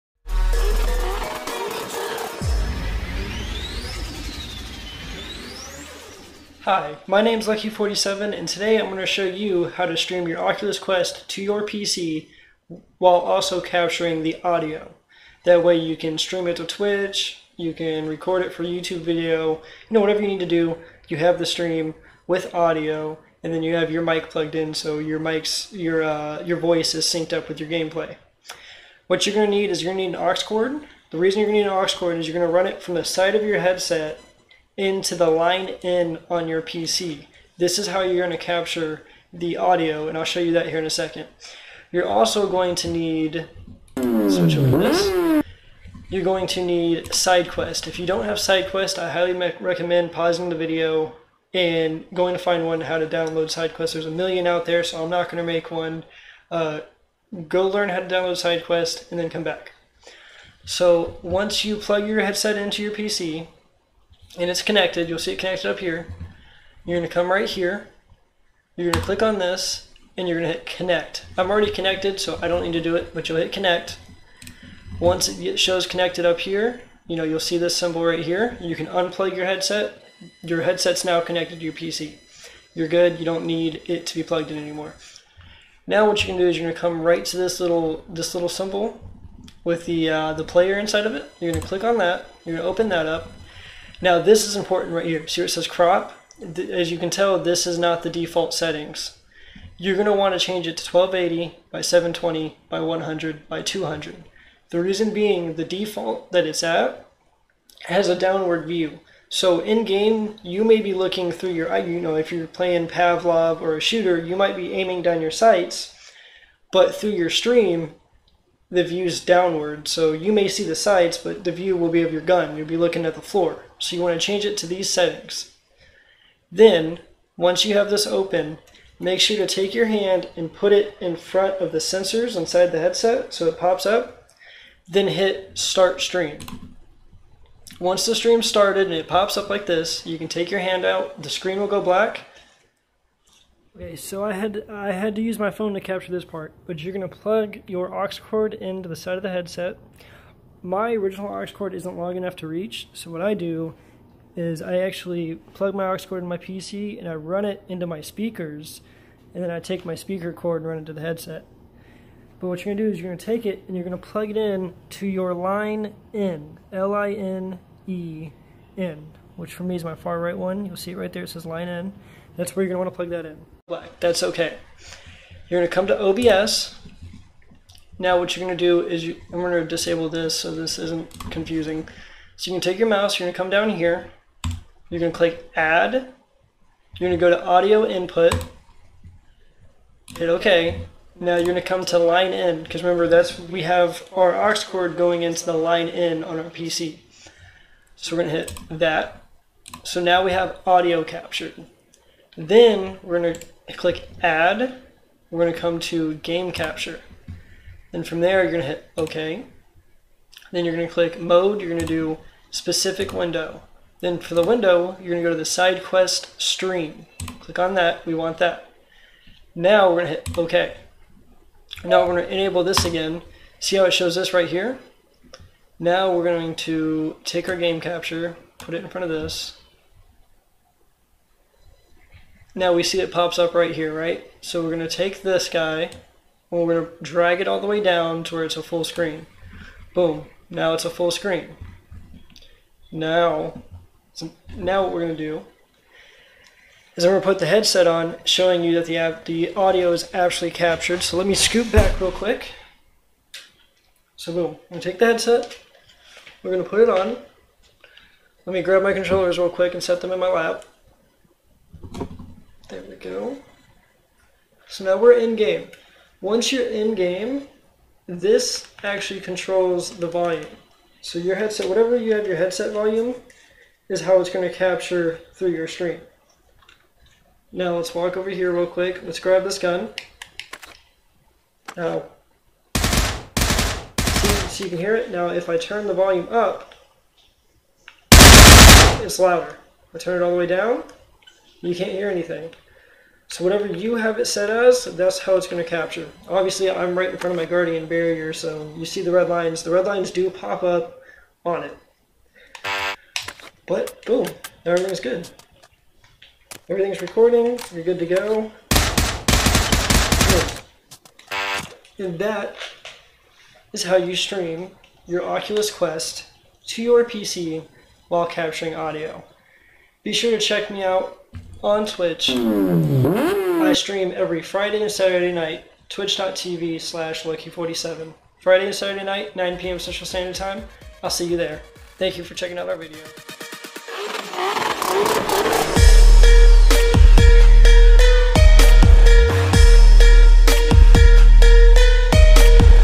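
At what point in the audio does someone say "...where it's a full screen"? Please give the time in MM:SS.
03:58.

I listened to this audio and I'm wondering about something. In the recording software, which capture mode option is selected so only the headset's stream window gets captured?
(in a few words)
Specific Window.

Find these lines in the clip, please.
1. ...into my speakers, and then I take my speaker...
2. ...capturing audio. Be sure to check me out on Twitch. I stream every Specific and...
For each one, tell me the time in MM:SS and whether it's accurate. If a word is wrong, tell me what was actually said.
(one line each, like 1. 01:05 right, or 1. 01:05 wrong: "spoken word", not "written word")
1. 02:37 right
2. 05:18 wrong: "Friday", not "Specific".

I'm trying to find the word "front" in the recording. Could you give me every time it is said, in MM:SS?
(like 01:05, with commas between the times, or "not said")
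02:11, 03:48, 04:57.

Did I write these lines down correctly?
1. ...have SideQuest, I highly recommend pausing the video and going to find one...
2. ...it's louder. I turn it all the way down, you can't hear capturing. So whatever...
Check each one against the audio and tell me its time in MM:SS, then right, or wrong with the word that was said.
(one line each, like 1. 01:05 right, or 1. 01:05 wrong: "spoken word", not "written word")
1. 00:48 right
2. 04:49 wrong: "anything", not "capturing".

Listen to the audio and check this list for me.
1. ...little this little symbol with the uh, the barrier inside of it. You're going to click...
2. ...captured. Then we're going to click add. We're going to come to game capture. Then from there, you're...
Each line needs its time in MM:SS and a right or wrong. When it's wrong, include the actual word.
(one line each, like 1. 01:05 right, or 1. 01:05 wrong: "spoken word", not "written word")
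1. 01:27 wrong: "player", not "barrier"
2. 03:21 right.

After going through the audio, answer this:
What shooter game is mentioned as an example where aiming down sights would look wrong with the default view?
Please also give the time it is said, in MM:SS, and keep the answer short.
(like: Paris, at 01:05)
Pavlov, at 01:52.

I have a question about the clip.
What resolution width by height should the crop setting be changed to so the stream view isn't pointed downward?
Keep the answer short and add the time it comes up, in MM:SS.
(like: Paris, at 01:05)
1280 by 720, at 01:40.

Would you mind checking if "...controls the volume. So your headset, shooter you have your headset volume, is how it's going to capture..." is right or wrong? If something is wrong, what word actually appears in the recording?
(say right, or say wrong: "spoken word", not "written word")
wrong: "whatever", not "shooter".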